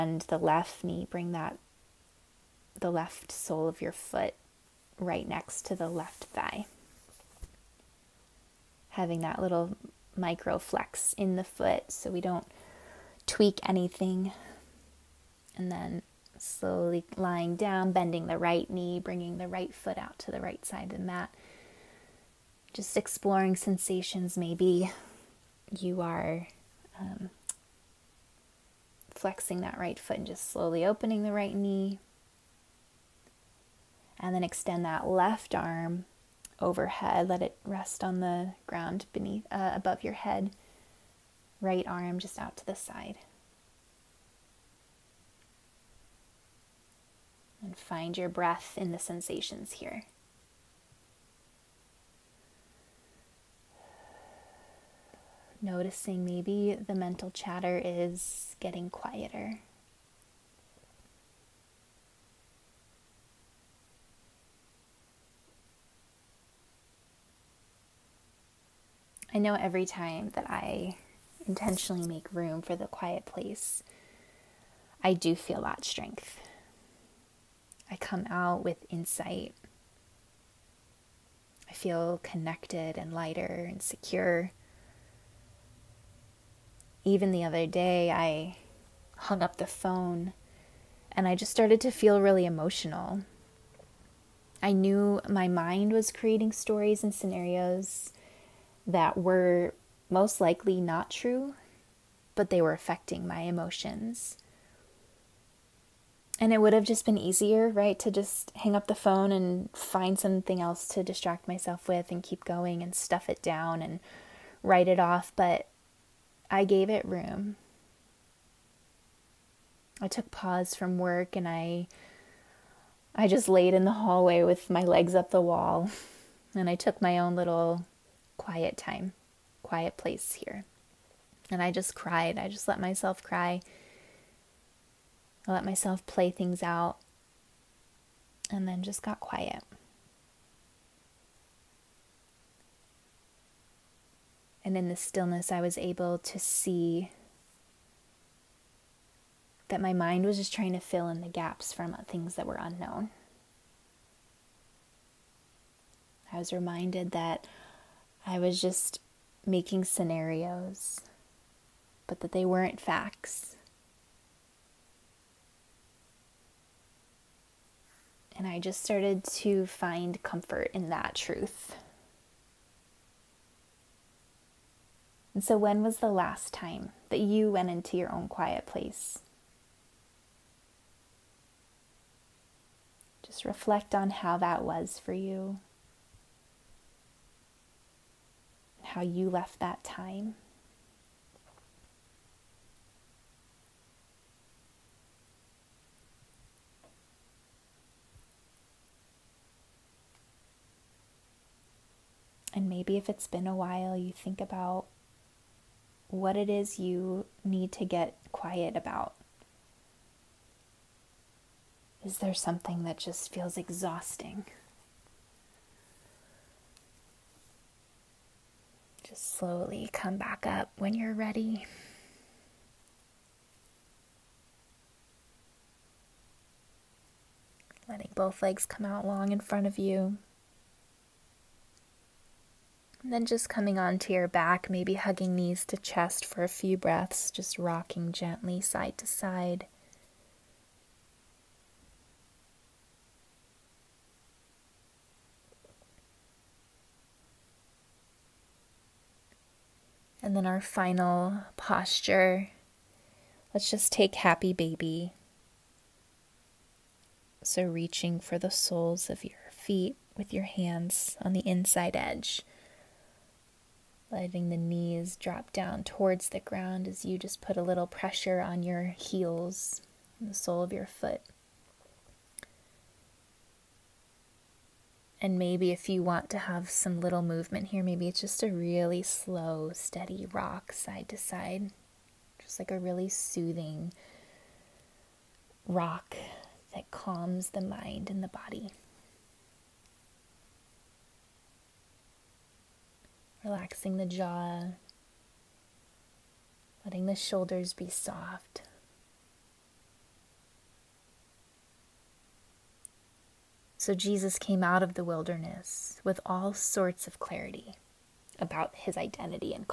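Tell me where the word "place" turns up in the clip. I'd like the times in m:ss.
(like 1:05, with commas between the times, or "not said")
1:13, 2:09, 2:58.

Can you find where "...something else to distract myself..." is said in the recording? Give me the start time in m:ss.
1:50.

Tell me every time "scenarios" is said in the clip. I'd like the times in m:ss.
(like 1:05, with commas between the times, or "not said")
1:37, 2:39.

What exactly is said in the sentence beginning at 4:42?
Just like a really soothing rock that calms the mind and the body.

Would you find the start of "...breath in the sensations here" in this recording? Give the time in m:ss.
0:48.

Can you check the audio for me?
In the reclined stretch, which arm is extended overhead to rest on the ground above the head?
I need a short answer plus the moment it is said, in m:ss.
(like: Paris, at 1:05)
Left arm, at 0:35.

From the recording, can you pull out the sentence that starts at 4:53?
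Relaxing the jaw, letting the shoulders be soft.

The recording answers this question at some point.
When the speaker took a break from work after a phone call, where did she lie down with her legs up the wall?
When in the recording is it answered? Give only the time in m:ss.
2:03.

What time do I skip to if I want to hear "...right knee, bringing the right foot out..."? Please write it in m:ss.
0:18.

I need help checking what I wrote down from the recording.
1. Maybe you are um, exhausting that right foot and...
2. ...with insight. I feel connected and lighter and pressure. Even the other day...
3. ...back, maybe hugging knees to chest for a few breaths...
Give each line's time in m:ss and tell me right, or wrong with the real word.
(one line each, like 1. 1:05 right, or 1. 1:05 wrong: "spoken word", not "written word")
1. 0:24 wrong: "flexing", not "exhausting"
2. 1:18 wrong: "secure", not "pressure"
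3. 3:54 right.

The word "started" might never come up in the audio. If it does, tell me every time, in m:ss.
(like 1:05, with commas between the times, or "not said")
1:31, 2:48.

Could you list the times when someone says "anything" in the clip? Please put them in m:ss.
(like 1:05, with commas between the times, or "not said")
0:13.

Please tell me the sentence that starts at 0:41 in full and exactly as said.
Right arm just out to the side.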